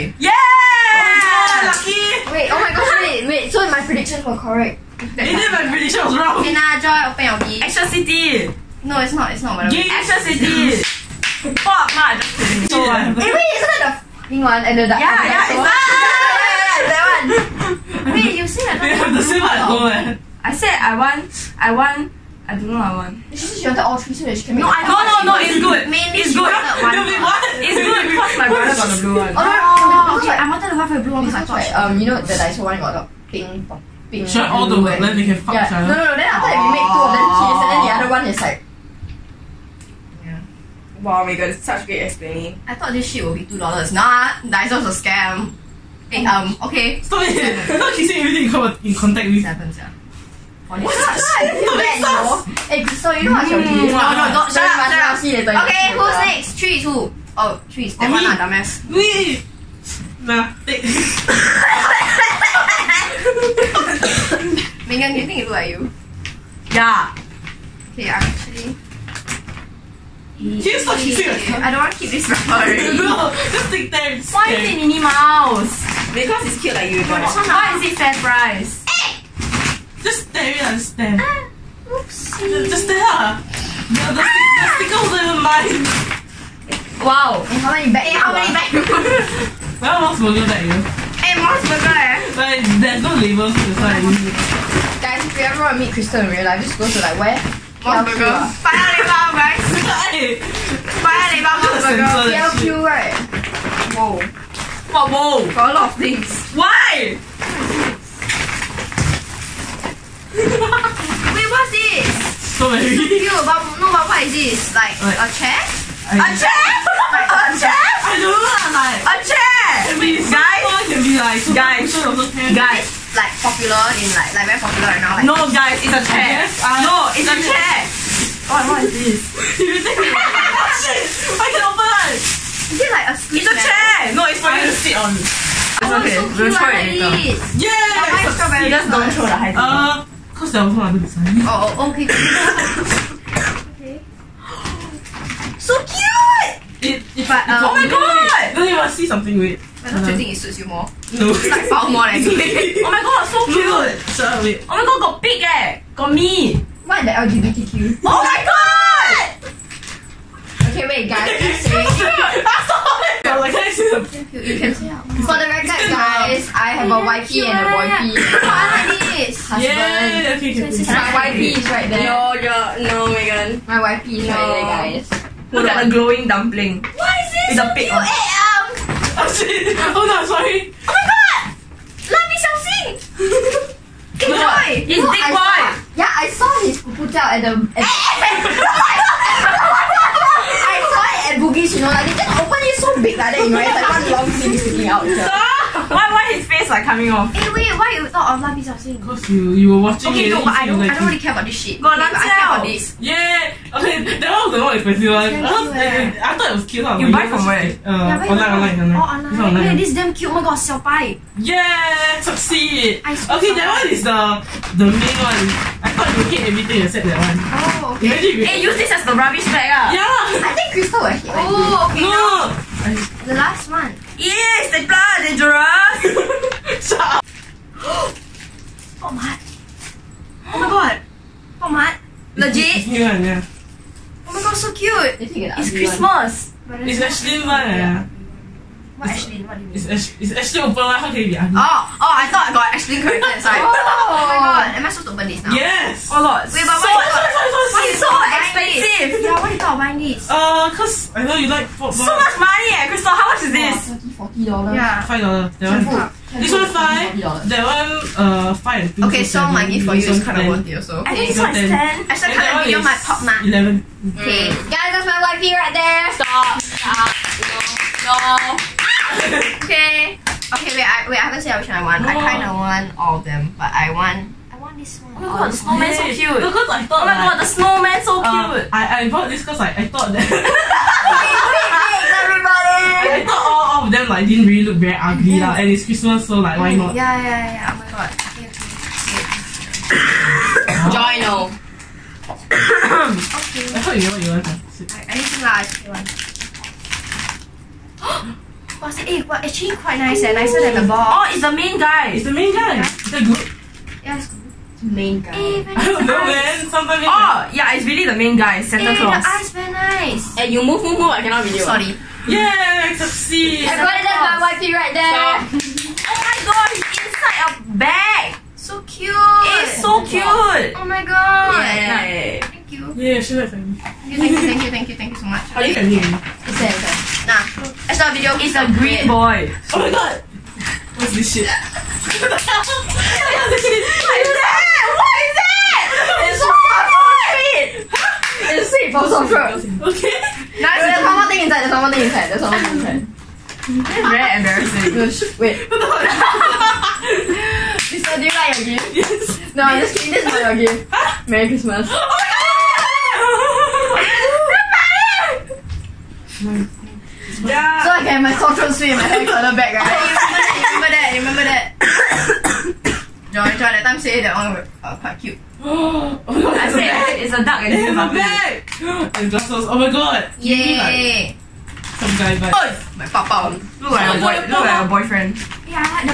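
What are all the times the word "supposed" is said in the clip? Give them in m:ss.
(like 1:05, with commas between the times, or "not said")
4:04.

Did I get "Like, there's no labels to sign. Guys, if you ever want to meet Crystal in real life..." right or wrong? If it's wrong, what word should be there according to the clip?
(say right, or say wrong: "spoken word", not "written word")
right.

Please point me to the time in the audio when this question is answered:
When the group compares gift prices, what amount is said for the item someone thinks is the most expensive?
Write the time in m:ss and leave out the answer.
4:23.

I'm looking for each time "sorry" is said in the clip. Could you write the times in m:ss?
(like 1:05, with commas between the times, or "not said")
2:34, 3:00, 5:11.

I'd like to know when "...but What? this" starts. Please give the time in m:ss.
1:53.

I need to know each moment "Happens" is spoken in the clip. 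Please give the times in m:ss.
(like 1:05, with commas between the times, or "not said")
0:49.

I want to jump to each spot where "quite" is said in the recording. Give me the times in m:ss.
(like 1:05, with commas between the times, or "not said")
4:59, 6:04.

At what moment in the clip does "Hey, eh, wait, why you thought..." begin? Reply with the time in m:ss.
3:17.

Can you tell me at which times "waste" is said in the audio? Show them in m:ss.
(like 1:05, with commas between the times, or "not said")
not said.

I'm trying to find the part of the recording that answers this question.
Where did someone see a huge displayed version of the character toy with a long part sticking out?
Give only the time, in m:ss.
3:11.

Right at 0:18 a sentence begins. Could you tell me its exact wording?
Wait, you said I don't have the same at home.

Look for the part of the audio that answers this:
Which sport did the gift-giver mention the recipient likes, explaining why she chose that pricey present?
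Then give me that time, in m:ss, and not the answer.
4:11.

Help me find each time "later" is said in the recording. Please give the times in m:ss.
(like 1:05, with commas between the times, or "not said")
0:55, 2:17.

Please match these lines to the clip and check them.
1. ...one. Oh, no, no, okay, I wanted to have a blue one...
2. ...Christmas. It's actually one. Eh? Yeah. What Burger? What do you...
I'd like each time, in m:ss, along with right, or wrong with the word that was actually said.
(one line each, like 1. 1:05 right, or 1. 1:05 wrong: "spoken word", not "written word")
1. 0:29 right
2. 3:55 wrong: "Ashlyn", not "Burger".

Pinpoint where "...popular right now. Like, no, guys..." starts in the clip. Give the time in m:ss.
2:04.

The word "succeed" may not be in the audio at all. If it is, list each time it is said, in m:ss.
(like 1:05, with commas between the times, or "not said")
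3:32, 5:12.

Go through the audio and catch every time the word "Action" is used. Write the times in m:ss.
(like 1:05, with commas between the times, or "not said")
0:07.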